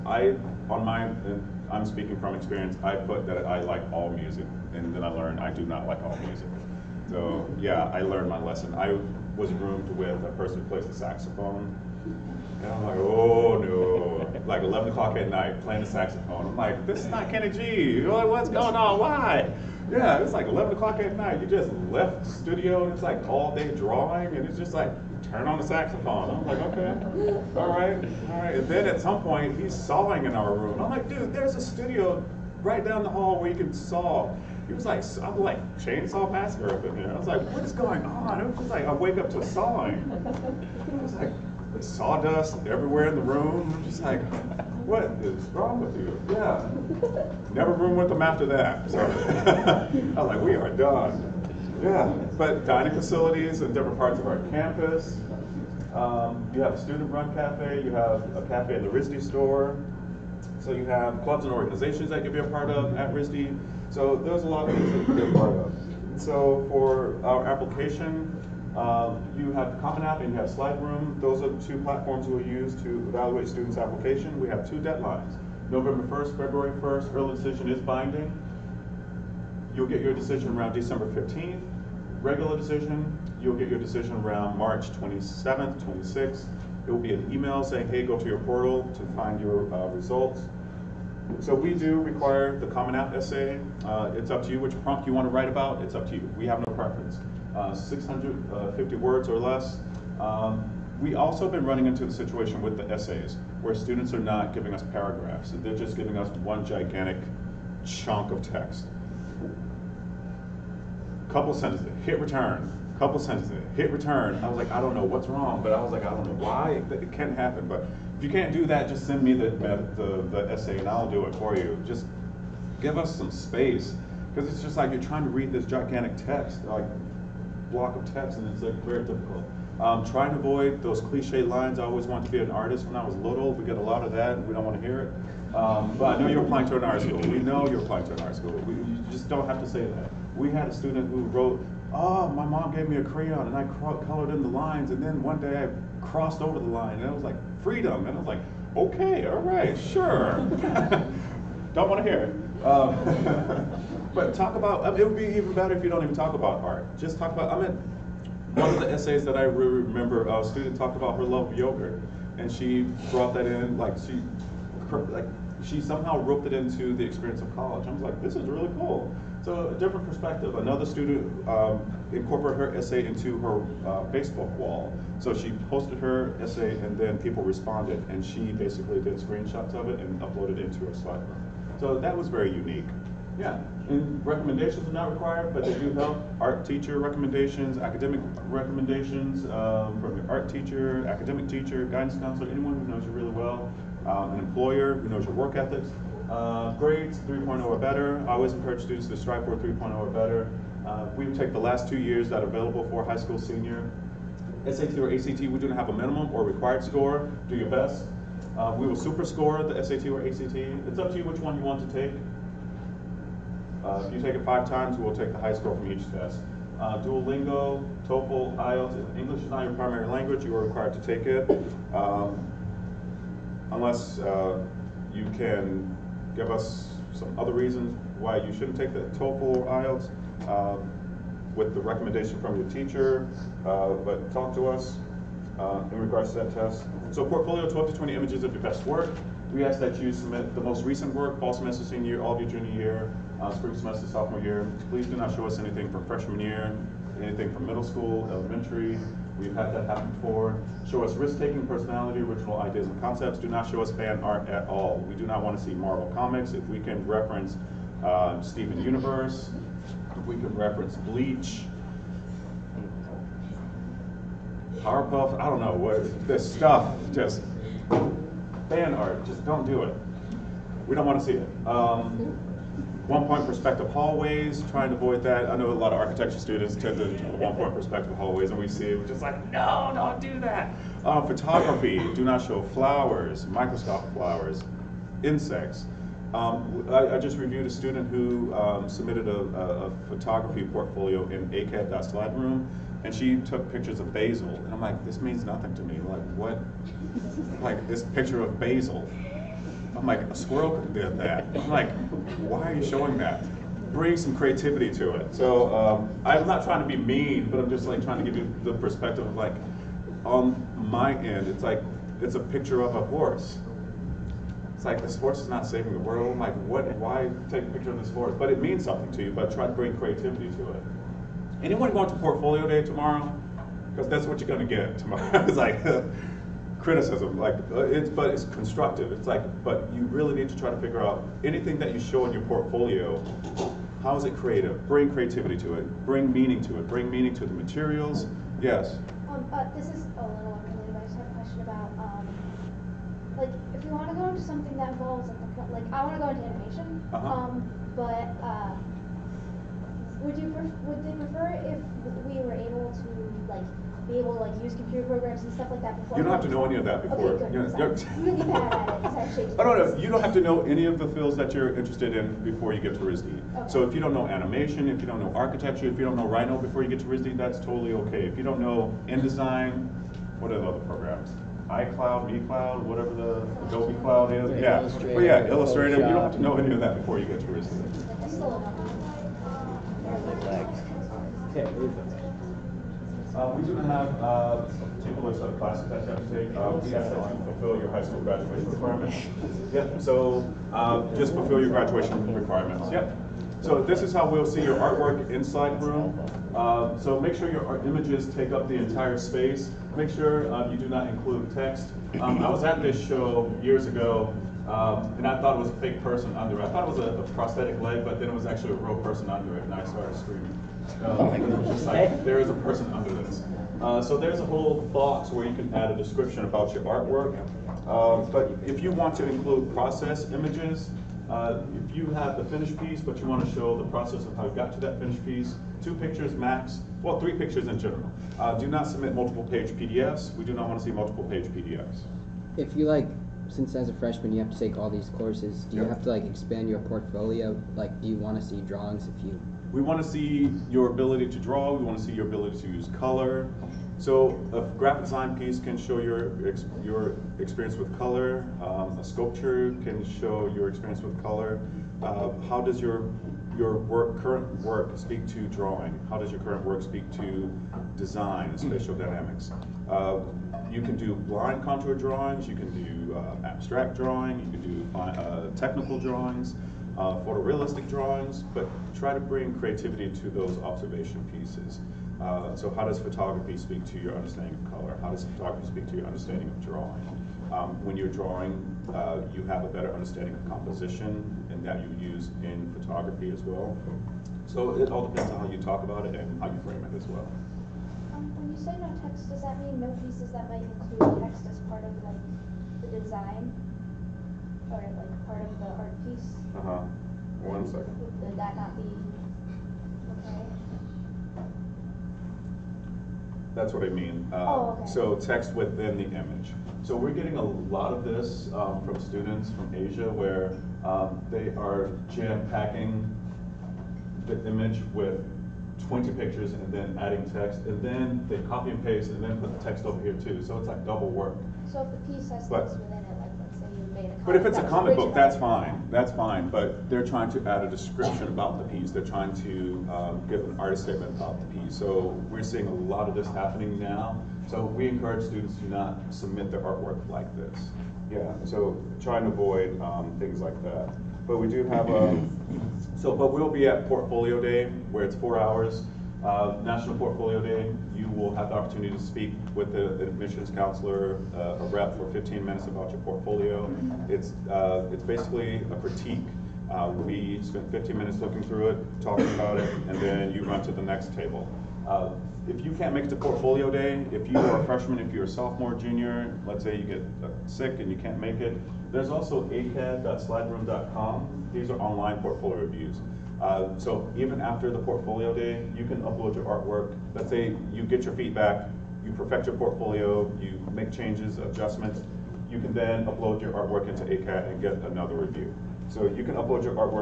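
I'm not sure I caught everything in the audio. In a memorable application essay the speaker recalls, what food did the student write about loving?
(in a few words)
yogurt.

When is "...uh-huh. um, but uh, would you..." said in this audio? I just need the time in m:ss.
5:47.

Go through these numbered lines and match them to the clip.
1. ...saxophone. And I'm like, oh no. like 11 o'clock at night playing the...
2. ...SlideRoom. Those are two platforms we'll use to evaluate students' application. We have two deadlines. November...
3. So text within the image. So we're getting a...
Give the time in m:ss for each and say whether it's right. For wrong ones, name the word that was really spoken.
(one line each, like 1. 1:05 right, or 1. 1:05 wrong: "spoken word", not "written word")
1. 0:10 right
2. 1:10 right
3. 8:24 right.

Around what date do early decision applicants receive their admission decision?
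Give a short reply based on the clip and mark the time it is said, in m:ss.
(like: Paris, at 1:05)
December 15th, at 1:20.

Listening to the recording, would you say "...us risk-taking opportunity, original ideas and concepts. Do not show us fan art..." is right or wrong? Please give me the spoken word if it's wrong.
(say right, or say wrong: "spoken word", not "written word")
wrong: "personality", not "opportunity".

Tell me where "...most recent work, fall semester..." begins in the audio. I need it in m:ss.
4:00.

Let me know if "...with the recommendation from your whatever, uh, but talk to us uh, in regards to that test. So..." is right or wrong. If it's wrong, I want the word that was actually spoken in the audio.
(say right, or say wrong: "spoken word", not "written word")
wrong: "teacher", not "whatever".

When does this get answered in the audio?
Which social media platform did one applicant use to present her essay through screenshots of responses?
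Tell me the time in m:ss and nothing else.
2:54.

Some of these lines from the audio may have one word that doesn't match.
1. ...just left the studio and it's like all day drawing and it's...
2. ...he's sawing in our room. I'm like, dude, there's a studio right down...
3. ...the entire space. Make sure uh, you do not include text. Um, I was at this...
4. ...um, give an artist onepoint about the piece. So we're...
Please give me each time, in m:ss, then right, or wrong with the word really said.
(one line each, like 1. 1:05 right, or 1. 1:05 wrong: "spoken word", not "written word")
1. 0:21 right
2. 0:29 right
3. 6:38 right
4. 8:49 wrong: "statement", not "onepoint".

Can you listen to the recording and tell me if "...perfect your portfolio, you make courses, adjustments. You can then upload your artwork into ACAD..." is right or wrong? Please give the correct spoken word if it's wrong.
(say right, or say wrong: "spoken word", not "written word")
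wrong: "changes", not "courses".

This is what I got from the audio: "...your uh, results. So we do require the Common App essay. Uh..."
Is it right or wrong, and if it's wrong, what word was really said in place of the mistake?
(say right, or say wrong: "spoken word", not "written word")
right.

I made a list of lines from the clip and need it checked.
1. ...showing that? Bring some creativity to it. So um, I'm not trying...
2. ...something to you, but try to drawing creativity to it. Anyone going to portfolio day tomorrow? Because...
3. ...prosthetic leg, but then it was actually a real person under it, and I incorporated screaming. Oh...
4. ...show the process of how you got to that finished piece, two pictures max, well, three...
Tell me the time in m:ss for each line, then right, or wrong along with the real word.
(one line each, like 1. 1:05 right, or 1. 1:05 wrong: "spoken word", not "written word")
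1. 5:02 right
2. 5:18 wrong: "bring", not "drawing"
3. 6:47 wrong: "started", not "incorporated"
4. 7:03 right.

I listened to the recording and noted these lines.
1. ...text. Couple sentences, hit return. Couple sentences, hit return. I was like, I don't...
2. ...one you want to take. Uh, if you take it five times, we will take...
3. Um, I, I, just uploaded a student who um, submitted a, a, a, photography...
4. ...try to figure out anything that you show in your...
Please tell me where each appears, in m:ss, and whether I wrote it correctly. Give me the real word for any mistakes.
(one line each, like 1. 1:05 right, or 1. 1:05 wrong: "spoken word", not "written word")
1. 1:48 right
2. 3:31 right
3. 4:46 wrong: "reviewed", not "uploaded"
4. 5:30 right.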